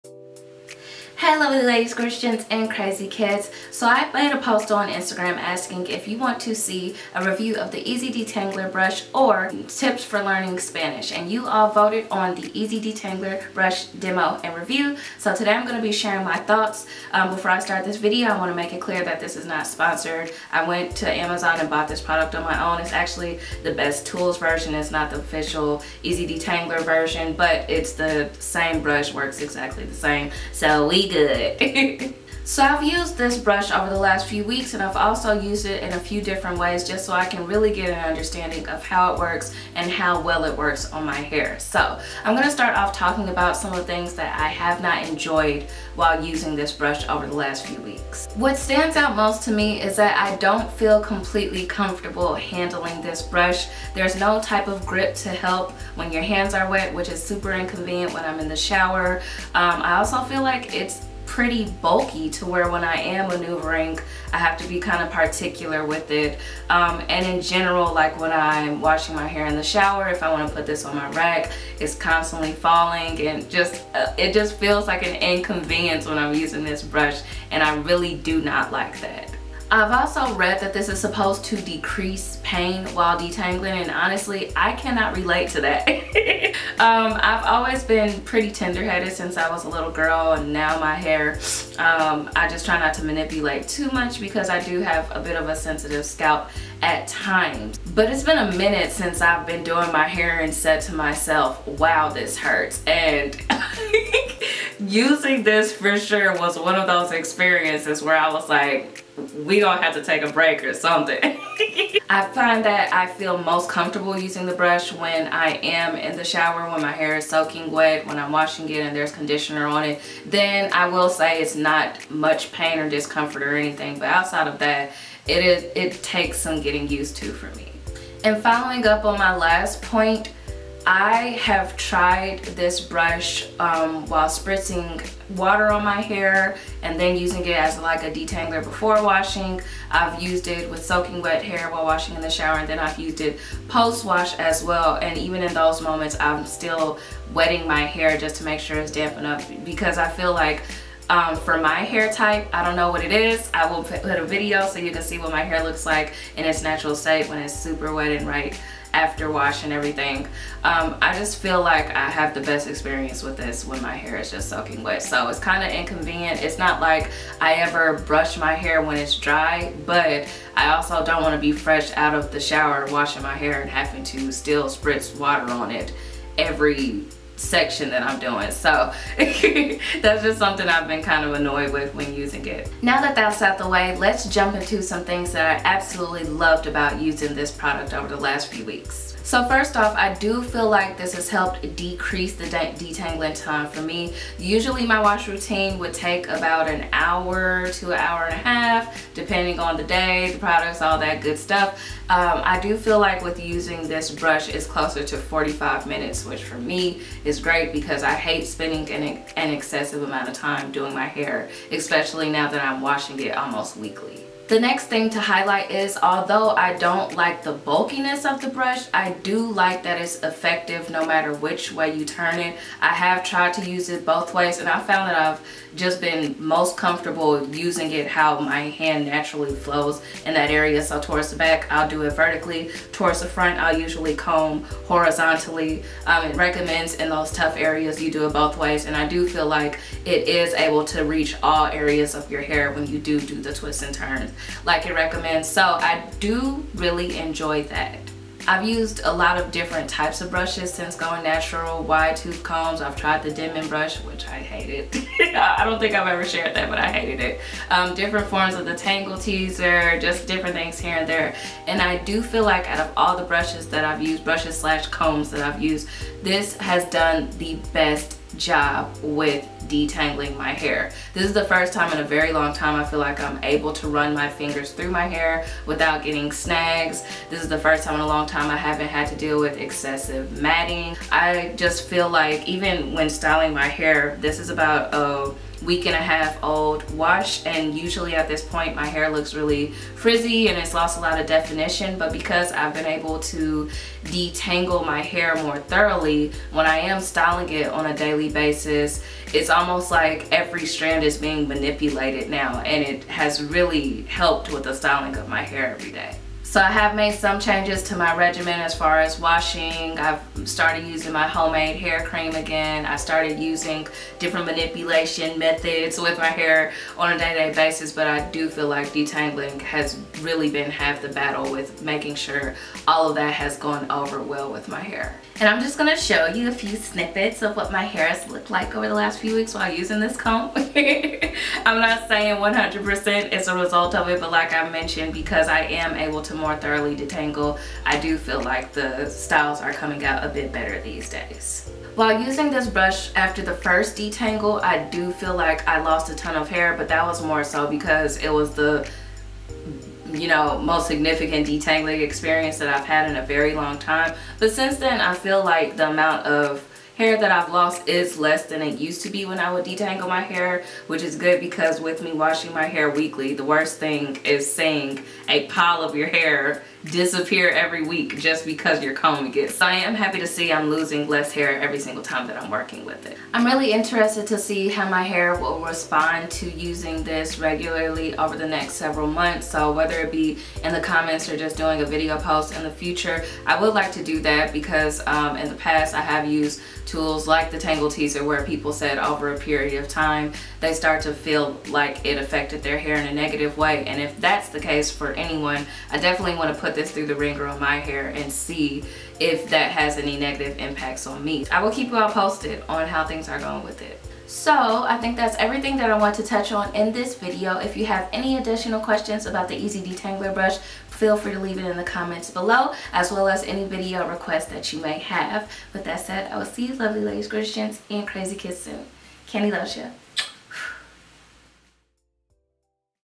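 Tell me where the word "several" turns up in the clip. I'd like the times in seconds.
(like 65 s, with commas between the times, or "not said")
378 s.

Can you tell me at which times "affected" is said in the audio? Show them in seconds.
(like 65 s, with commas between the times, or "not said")
392 s.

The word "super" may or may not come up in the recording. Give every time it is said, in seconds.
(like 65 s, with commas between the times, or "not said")
57 s, 157 s.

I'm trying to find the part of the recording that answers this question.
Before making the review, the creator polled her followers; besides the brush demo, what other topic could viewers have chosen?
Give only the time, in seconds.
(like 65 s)
9 s.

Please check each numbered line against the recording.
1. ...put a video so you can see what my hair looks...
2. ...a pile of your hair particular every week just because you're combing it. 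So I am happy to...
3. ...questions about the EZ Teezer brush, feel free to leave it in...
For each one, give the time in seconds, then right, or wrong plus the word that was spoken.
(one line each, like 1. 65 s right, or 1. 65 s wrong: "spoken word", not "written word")
1. 153 s right
2. 365 s wrong: "disappear", not "particular"
3. 408 s wrong: "Detangler", not "Teezer".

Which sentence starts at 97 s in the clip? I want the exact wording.
But it's been a minute since I've been doing my hair and said to myself, wow, this hurts.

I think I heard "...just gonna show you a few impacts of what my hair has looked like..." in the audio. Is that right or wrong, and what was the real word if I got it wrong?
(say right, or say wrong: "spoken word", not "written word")
wrong: "snippets", not "impacts".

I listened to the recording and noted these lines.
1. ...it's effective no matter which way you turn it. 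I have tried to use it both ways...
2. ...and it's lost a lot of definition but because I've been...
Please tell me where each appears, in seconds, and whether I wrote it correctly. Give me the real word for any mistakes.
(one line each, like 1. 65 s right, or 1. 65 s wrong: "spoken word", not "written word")
1. 220 s right
2. 290 s right.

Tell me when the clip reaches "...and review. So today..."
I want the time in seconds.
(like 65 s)
14 s.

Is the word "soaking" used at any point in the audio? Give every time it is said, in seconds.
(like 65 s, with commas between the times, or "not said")
117 s, 140 s, 164 s.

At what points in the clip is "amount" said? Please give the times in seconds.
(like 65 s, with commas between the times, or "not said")
210 s, 355 s.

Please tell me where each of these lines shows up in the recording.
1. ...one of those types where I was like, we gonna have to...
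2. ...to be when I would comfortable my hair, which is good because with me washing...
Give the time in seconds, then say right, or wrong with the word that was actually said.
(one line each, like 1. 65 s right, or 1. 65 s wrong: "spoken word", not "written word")
1. 106 s wrong: "experiences", not "types"
2. 359 s wrong: "detangle", not "comfortable".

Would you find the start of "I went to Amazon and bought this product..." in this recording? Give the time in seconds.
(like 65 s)
20 s.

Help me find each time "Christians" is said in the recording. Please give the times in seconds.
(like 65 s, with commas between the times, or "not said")
1 s, 417 s.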